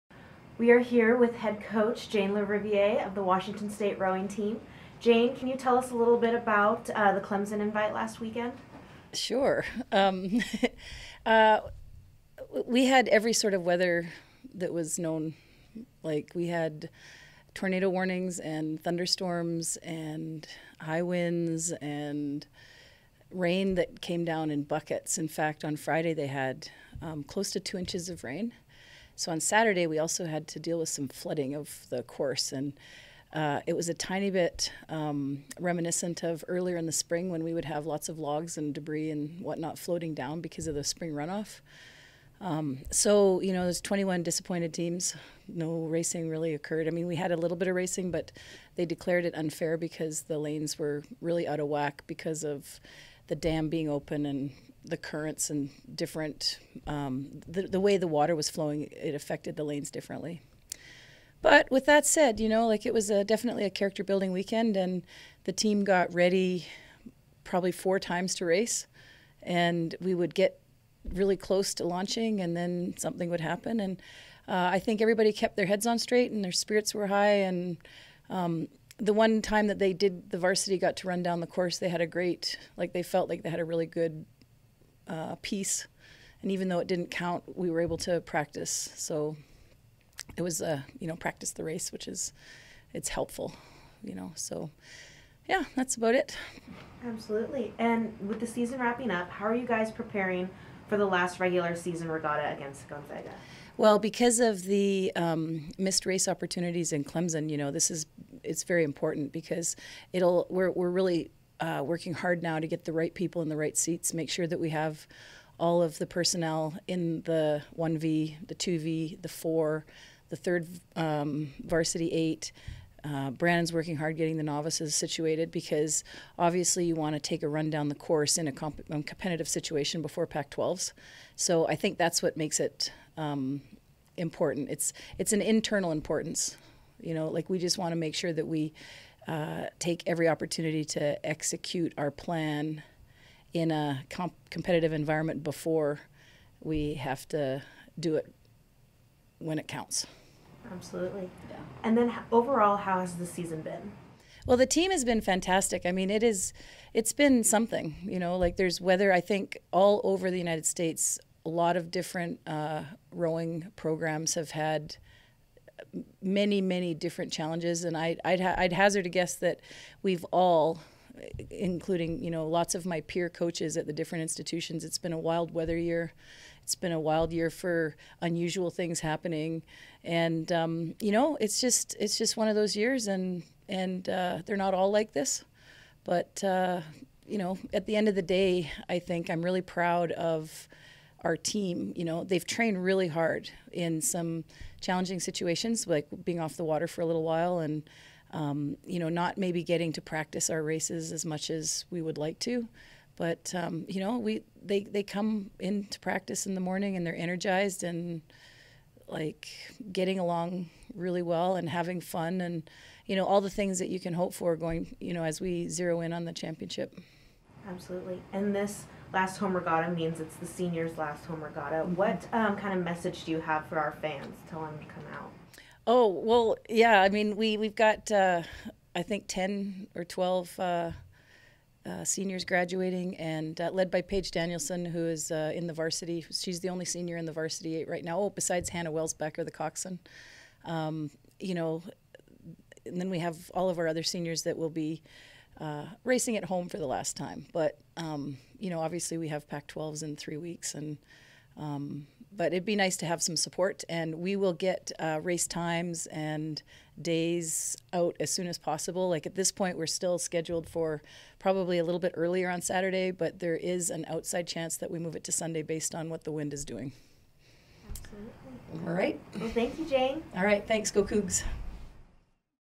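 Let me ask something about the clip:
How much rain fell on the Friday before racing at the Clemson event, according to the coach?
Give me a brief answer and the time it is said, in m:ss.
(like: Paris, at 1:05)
close to 2 inches, at 0:27.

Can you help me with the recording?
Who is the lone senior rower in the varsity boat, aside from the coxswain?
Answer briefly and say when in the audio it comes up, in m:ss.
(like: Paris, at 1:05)
Paige Danielson, at 3:54.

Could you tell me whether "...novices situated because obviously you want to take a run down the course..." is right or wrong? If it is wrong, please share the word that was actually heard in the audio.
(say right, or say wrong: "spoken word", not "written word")
right.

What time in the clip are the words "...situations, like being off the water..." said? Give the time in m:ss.
3:15.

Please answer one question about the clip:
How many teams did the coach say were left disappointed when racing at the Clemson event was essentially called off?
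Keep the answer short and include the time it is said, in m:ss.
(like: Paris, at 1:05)
21, at 0:43.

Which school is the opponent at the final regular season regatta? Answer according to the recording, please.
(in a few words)
Gonzaga.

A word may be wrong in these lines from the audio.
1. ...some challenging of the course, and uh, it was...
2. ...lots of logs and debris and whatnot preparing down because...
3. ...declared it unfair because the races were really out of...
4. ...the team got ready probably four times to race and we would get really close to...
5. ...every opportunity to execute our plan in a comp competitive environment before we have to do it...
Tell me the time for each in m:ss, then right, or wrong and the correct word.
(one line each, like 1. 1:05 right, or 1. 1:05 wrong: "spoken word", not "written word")
1. 0:30 wrong: "flooding", not "challenging"
2. 0:37 wrong: "floating", not "preparing"
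3. 0:48 wrong: "lanes", not "races"
4. 1:05 right
5. 2:20 right.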